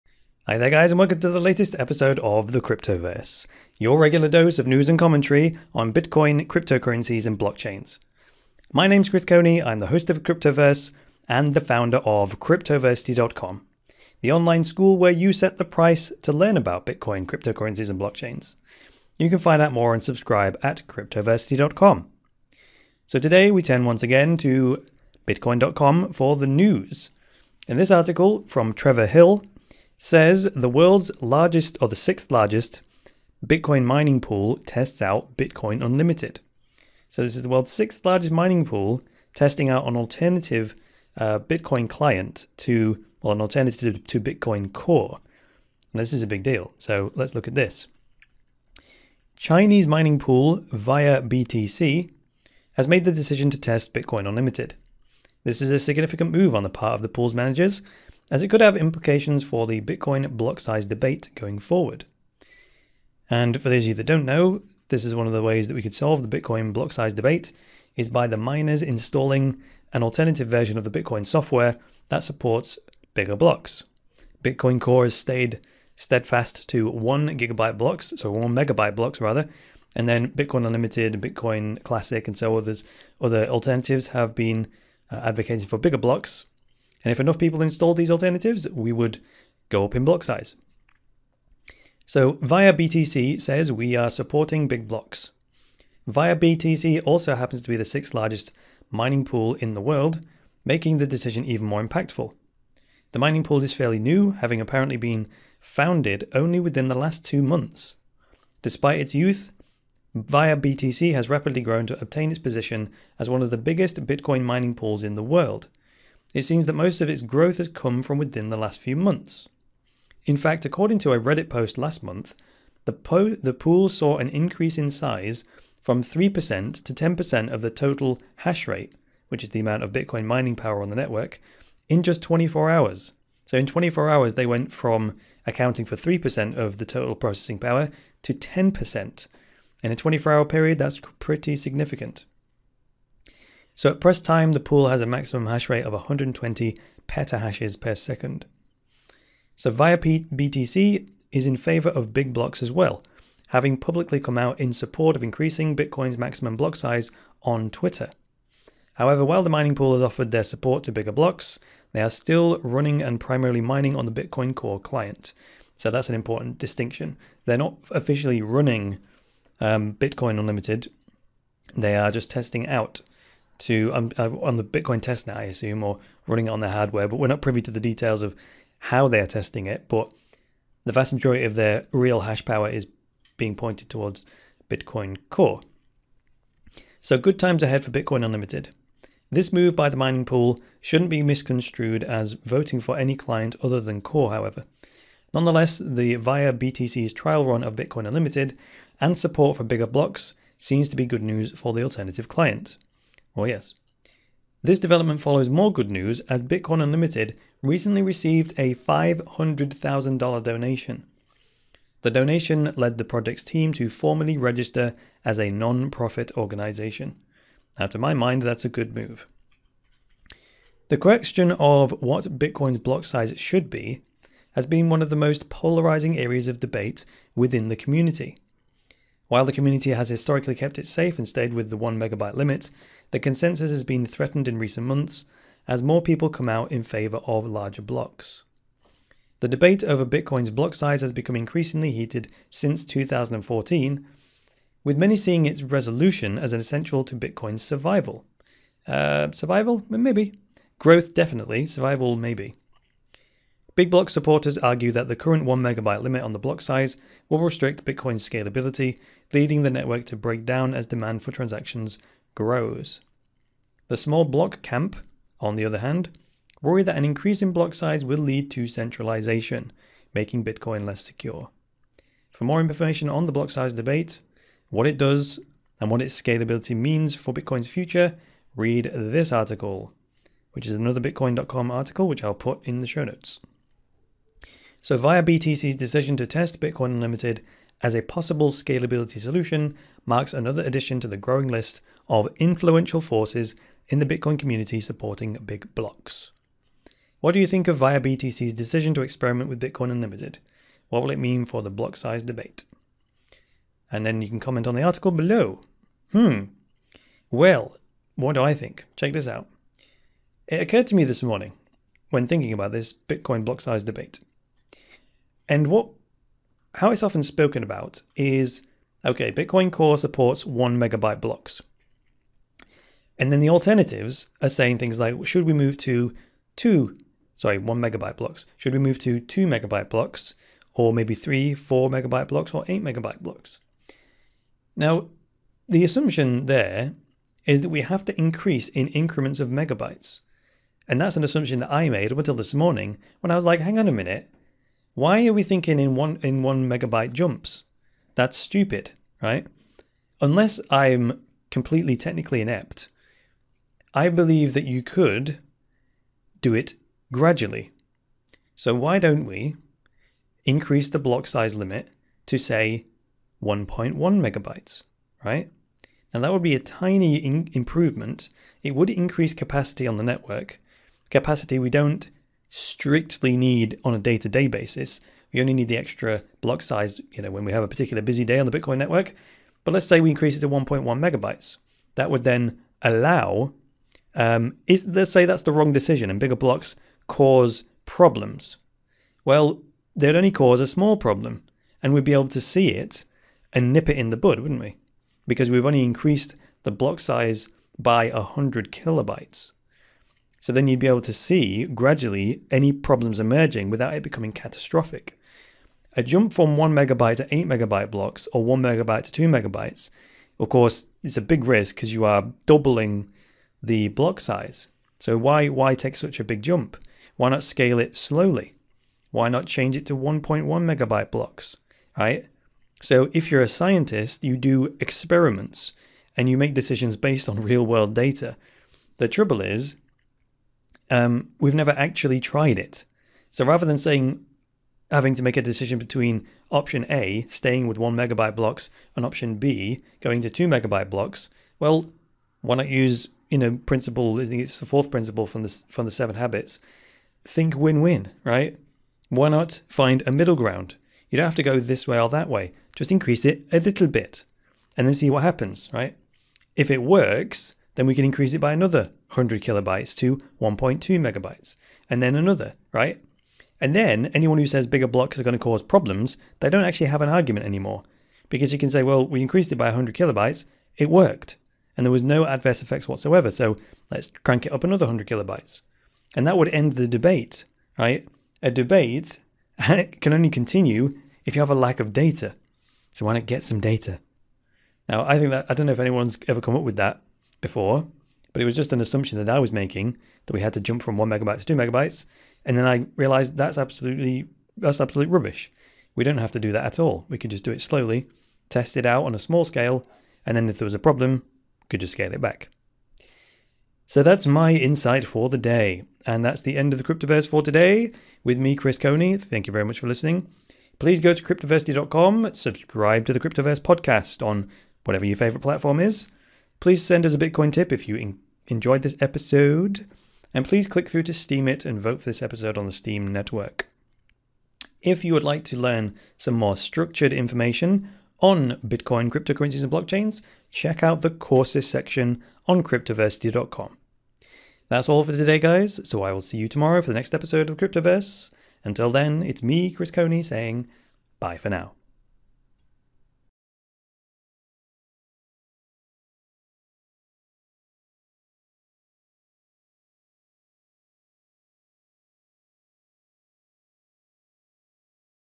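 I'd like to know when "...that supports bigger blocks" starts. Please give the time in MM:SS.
01:12.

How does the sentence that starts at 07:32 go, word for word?
Just increase it a little bit, and then see what happens, right?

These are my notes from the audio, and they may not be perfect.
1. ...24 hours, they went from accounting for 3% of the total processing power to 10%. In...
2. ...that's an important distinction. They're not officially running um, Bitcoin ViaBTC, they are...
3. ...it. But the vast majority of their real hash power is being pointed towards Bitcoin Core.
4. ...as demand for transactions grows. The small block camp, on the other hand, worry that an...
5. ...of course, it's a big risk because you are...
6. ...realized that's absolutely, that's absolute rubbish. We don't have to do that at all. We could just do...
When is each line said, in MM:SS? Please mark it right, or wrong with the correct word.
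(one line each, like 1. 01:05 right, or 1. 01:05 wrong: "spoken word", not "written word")
1. 02:13 right
2. 02:45 wrong: "Unlimited", not "ViaBTC"
3. 02:59 right
4. 04:20 right
5. 06:50 right
6. 08:12 right.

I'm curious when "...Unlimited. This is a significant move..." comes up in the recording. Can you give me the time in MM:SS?
00:54.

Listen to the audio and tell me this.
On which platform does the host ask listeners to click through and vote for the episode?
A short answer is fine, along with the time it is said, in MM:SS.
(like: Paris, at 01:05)
Steemit, at 08:41.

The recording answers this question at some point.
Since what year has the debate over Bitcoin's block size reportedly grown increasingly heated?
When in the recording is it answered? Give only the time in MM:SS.
04:02.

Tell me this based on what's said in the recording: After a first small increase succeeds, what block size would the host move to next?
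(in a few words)
1.2 megabytes.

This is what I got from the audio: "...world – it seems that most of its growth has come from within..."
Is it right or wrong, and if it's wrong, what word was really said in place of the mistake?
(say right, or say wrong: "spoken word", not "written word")
right.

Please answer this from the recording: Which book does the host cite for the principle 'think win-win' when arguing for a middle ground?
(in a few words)
the Seven Habits.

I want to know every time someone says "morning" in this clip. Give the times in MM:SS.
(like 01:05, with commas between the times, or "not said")
05:11, 05:42.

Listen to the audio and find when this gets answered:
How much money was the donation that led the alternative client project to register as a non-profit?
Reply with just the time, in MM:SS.
03:28.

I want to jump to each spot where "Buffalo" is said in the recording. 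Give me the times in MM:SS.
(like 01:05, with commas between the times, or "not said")
not said.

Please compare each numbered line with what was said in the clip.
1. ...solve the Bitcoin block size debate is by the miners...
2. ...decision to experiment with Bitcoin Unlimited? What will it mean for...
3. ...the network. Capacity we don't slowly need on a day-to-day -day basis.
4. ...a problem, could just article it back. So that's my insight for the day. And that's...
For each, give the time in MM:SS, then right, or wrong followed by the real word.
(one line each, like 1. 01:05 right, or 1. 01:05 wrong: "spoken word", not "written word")
1. 01:05 right
2. 04:58 right
3. 06:09 wrong: "strictly", not "slowly"
4. 08:20 wrong: "scale", not "article".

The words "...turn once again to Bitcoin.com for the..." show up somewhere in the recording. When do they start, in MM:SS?
00:23.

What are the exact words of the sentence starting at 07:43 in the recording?
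And then anyone who says bigger blocks are going to cause problems, they don't actually have an argument anymore.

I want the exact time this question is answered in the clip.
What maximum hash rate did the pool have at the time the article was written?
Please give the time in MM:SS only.
02:25.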